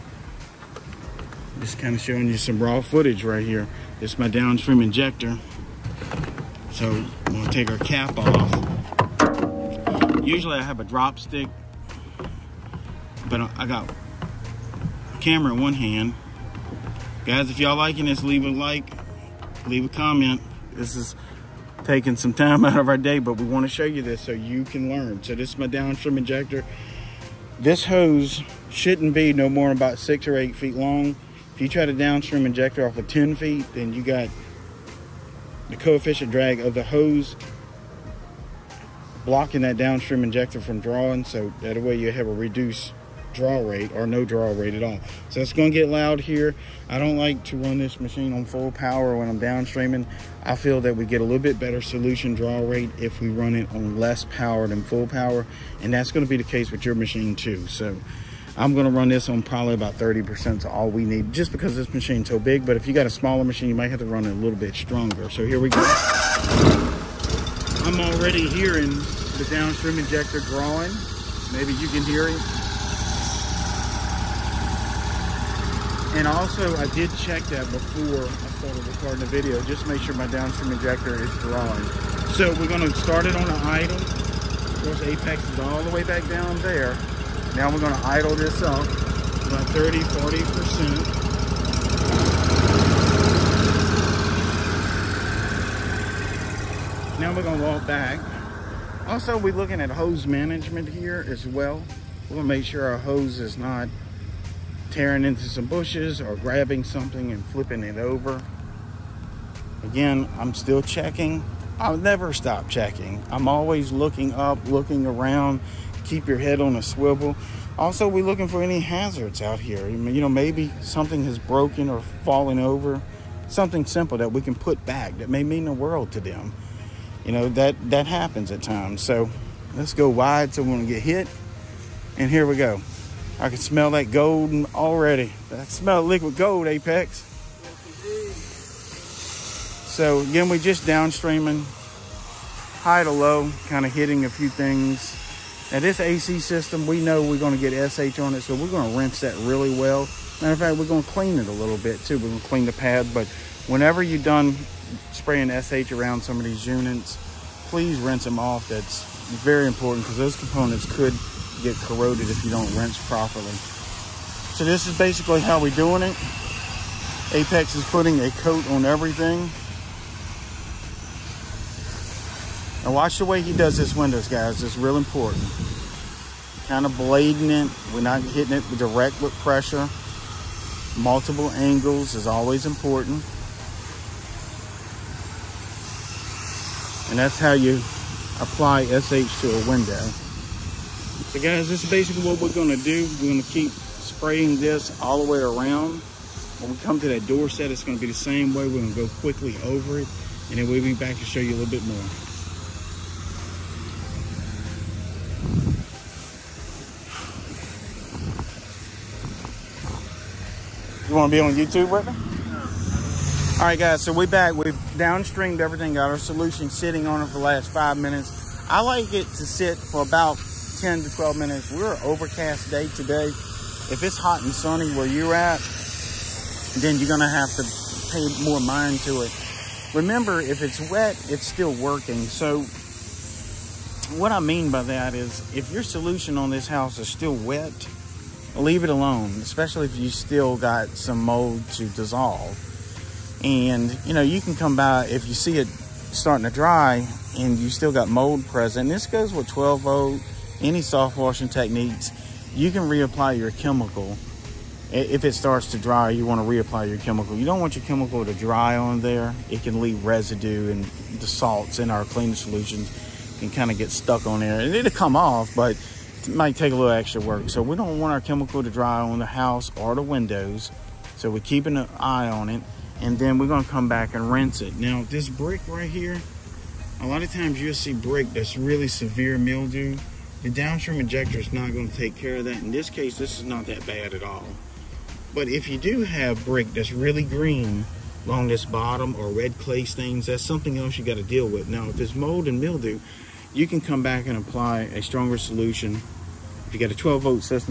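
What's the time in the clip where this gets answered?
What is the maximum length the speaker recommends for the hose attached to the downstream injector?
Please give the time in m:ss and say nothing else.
0:29.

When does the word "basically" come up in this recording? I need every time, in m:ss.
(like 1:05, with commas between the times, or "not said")
2:44, 3:11.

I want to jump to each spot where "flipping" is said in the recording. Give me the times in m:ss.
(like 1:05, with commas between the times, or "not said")
1:47.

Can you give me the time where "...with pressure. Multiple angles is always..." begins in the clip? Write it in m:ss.
2:59.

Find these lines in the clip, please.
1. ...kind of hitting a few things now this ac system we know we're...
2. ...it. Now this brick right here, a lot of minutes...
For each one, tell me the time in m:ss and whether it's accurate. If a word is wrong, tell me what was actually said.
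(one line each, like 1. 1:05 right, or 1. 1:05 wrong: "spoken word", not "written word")
1. 2:23 right
2. 4:34 wrong: "times", not "minutes".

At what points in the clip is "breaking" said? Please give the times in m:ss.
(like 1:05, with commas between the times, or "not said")
not said.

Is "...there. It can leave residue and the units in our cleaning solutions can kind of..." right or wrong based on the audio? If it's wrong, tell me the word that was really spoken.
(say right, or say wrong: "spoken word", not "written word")
wrong: "salts", not "units".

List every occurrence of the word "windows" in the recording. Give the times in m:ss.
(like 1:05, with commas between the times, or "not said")
2:53, 3:09, 4:30.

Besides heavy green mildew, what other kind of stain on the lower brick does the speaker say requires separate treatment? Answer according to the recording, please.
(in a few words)
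red clay stains.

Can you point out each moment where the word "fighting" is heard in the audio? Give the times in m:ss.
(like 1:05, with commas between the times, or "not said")
not said.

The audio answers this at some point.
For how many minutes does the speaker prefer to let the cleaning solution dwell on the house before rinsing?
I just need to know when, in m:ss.
3:40.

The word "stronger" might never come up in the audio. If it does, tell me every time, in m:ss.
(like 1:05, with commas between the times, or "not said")
1:04, 4:55.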